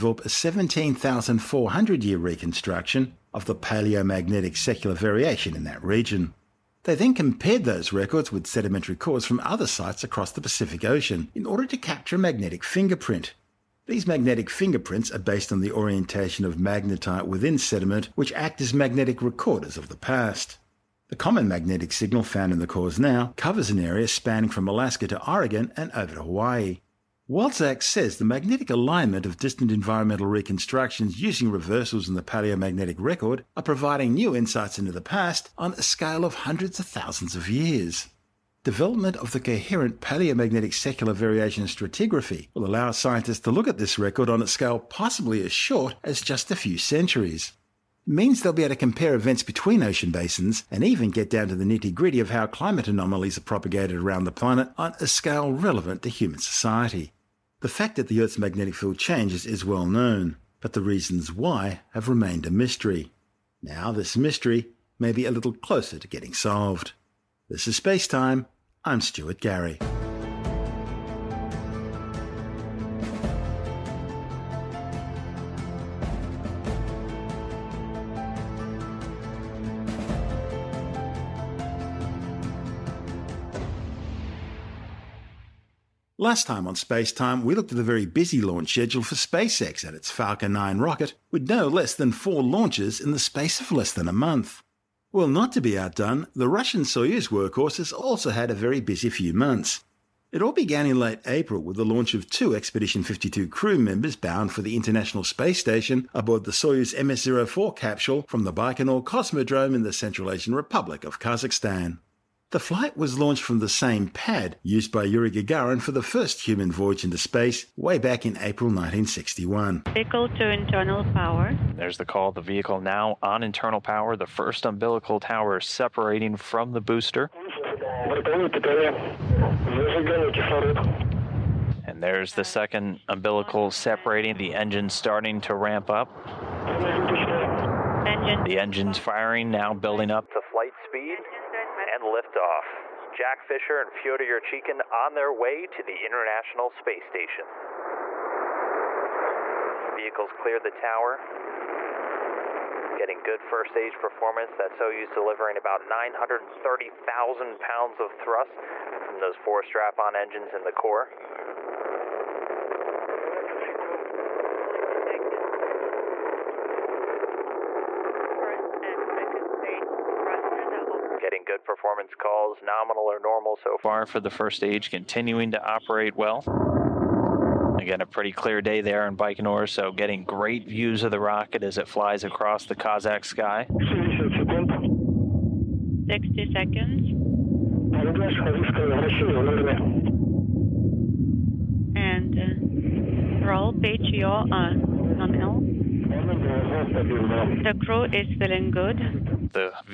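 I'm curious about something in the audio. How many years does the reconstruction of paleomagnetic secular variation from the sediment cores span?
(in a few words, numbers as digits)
17,400.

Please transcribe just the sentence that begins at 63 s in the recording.
Now, this mystery may be a little closer to getting solved.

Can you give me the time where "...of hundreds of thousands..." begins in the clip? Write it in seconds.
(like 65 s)
36 s.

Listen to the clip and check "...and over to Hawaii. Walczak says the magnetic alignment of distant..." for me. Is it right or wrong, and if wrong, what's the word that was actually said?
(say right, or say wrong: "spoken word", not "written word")
right.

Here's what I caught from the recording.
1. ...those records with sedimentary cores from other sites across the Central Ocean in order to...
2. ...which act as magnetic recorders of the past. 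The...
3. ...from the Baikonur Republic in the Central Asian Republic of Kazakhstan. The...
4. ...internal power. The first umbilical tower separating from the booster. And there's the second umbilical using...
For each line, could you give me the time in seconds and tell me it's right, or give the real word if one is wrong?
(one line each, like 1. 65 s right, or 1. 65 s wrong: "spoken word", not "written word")
1. 7 s wrong: "Pacific", not "Central"
2. 18 s right
3. 108 s wrong: "Cosmodrome", not "Republic"
4. 123 s wrong: "separating", not "using".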